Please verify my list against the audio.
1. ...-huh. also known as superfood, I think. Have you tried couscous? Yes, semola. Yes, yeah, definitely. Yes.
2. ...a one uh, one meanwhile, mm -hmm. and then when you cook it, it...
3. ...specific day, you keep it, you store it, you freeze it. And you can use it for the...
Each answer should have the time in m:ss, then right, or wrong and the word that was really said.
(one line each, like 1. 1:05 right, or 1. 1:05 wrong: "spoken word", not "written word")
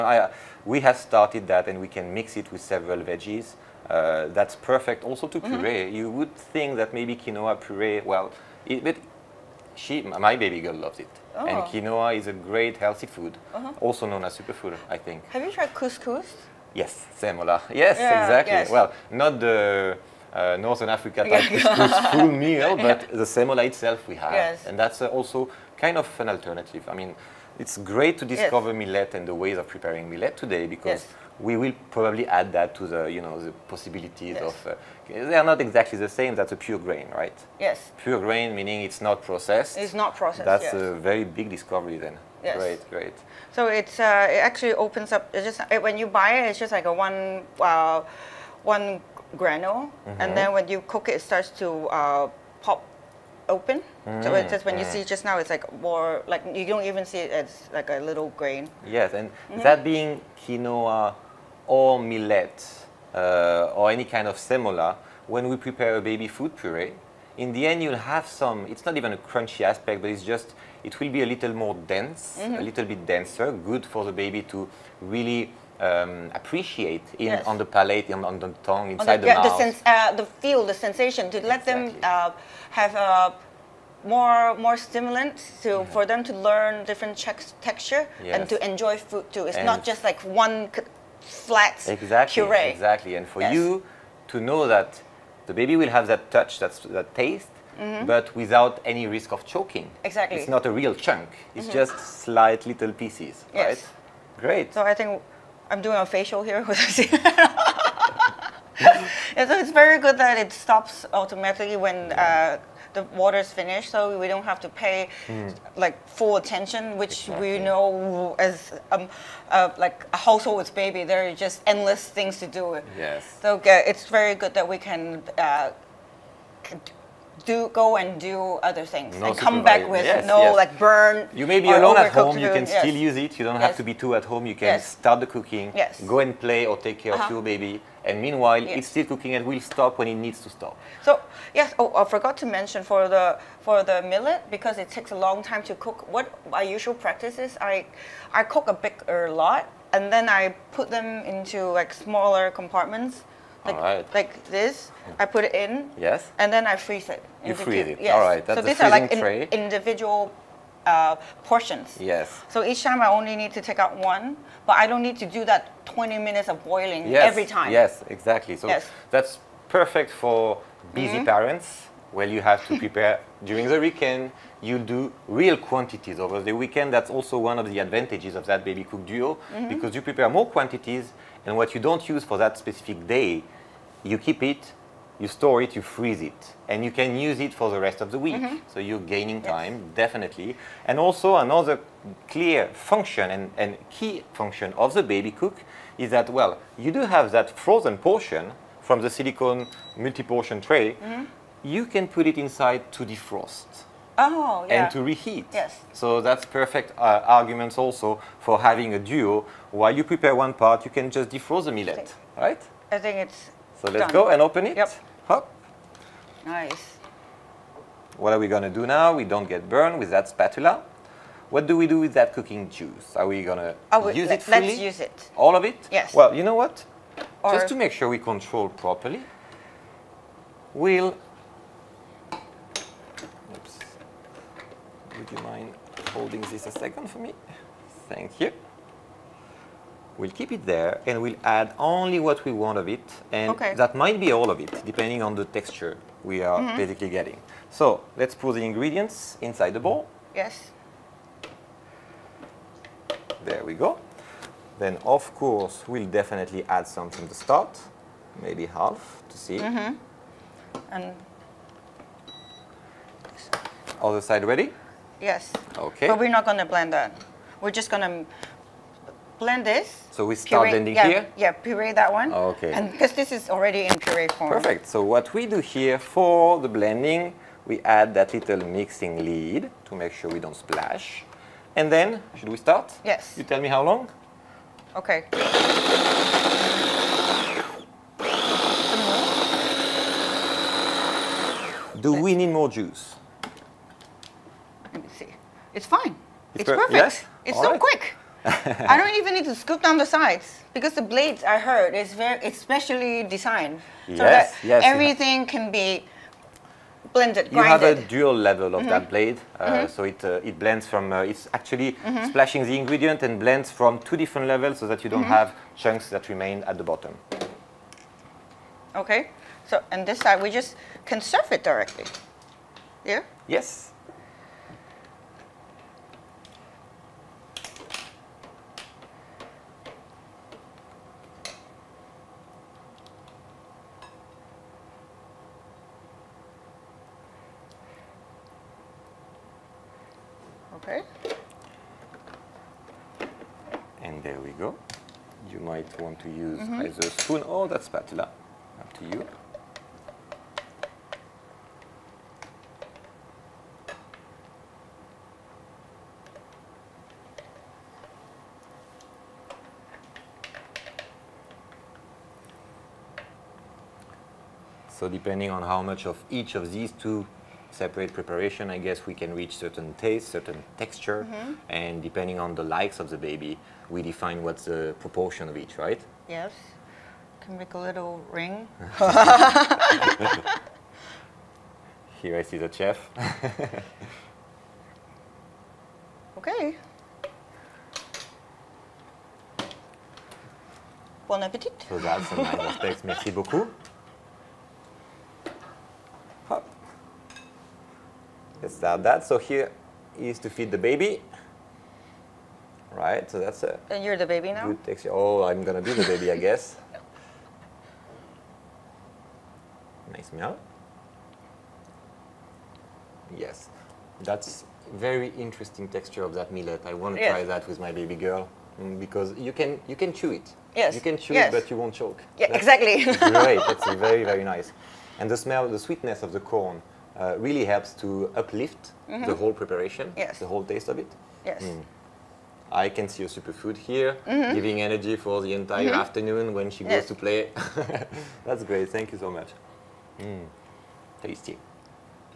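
1. 0:13 wrong: "exactly", not "definitely"
2. 0:46 wrong: "granule", not "meanwhile"
3. 3:02 right.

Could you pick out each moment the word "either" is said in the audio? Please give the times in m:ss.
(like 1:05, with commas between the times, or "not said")
5:46.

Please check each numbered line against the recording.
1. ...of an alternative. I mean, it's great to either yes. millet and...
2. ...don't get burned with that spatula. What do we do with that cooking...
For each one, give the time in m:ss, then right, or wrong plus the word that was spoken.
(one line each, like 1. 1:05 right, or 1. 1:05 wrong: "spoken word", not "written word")
1. 0:25 wrong: "discover", not "either"
2. 3:39 right.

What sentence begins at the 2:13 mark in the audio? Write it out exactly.
You don't have to be two at home.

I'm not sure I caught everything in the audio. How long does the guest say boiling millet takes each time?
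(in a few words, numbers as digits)
20 minutes.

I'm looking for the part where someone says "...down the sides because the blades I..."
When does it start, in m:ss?
4:59.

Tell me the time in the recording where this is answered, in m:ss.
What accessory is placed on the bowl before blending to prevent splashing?
4:38.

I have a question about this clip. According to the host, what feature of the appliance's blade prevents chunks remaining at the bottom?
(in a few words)
dual level.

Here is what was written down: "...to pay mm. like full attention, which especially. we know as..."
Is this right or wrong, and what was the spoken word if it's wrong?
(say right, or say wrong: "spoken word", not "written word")
wrong: "exactly", not "especially".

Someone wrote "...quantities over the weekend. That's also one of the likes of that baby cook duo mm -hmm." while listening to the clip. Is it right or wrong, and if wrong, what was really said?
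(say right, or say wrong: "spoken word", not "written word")
wrong: "advantages", not "likes".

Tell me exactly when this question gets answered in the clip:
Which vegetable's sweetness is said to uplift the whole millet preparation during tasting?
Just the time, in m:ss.
7:06.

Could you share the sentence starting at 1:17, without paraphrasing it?
on the palate, on, on the tongue, inside the, the, mouth.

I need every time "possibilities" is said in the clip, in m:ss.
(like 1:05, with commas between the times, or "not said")
0:33.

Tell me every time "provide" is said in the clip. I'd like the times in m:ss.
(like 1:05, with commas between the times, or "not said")
not said.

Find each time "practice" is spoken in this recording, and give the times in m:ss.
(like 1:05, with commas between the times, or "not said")
2:27.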